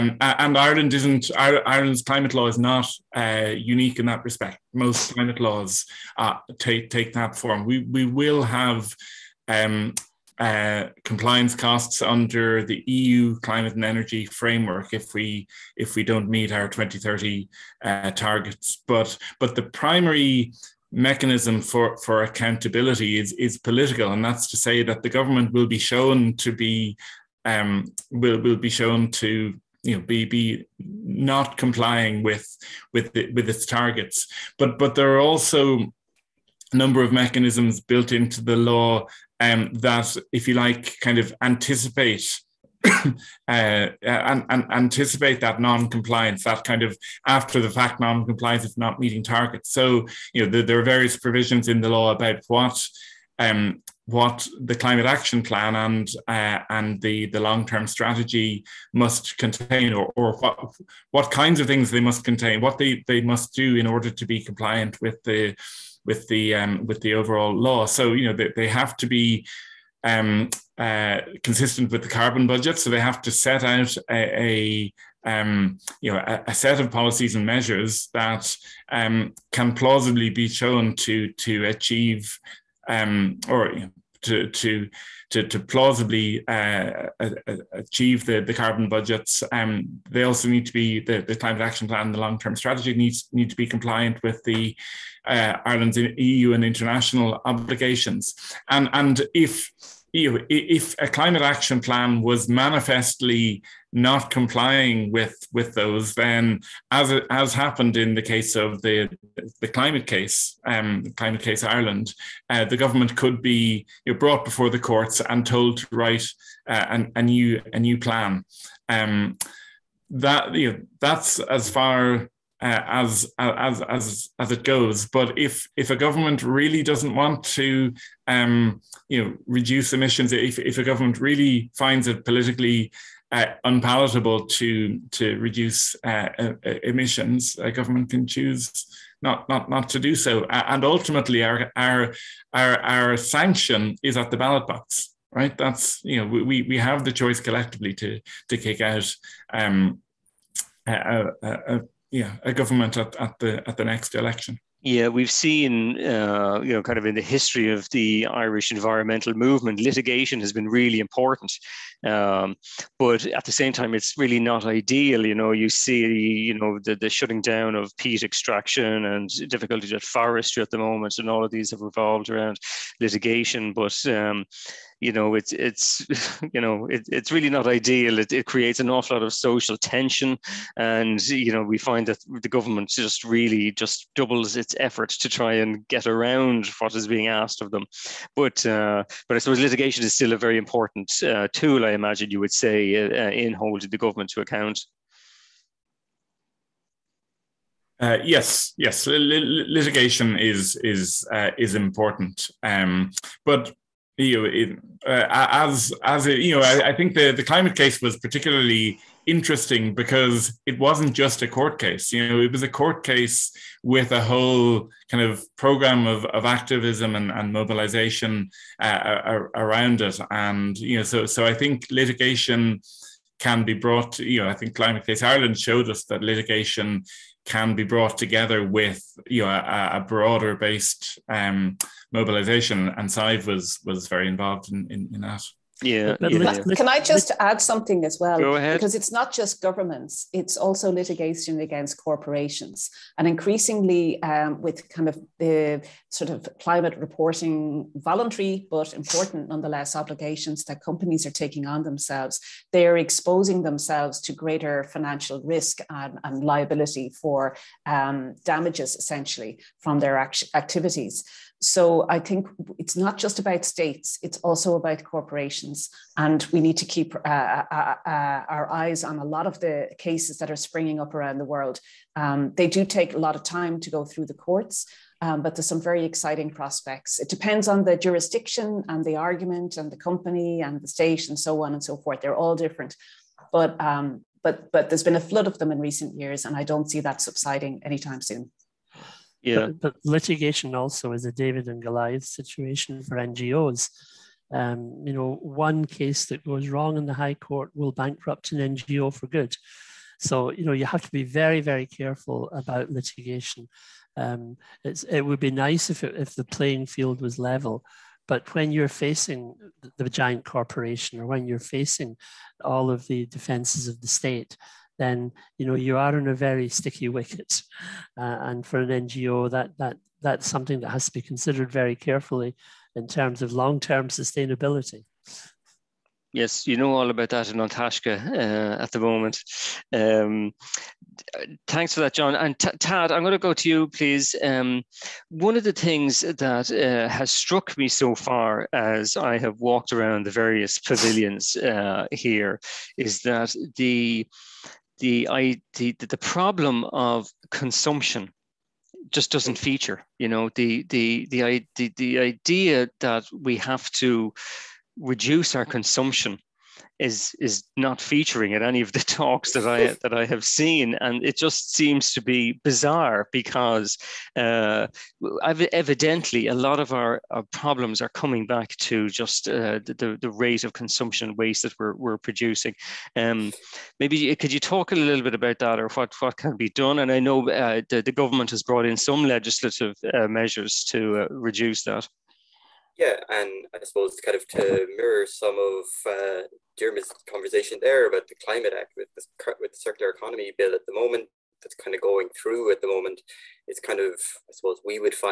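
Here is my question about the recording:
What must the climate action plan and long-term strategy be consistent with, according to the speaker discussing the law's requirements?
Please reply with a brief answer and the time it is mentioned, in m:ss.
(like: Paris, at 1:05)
The carbon budget, at 1:12.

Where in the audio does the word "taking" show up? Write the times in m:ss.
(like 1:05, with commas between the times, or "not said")
4:11.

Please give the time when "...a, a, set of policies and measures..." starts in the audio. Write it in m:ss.
1:16.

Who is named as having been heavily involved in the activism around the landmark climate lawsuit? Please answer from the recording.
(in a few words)
Sadhbh.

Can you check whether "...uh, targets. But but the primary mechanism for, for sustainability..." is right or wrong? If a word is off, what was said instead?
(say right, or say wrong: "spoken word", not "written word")
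wrong: "accountability", not "sustainability".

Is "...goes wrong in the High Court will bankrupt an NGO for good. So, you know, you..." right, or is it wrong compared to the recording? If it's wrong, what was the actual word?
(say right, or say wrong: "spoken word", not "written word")
right.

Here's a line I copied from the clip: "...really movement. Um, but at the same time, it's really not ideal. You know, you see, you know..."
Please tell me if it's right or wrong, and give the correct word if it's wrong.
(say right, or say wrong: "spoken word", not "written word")
wrong: "important", not "movement".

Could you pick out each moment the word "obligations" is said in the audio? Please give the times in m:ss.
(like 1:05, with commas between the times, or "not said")
1:37, 4:09.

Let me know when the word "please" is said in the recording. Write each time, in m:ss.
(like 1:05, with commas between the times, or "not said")
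5:33.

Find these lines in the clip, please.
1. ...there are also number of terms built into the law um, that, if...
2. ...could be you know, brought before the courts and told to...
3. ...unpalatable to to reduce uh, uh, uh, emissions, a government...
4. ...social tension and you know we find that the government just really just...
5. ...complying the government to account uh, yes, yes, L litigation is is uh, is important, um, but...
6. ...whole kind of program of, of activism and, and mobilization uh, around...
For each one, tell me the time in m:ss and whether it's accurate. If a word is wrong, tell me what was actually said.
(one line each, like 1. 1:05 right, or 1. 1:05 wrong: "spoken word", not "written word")
1. 0:34 wrong: "mechanisms", not "terms"
2. 1:53 right
3. 2:13 right
4. 2:59 right
5. 3:13 wrong: "holding", not "complying"
6. 3:34 right.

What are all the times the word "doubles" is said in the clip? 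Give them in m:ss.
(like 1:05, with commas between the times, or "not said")
3:04.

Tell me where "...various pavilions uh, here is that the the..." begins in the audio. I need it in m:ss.
5:40.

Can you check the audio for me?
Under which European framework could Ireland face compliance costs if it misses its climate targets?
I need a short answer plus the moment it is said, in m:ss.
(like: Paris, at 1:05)
EU climate and energy framework, at 0:12.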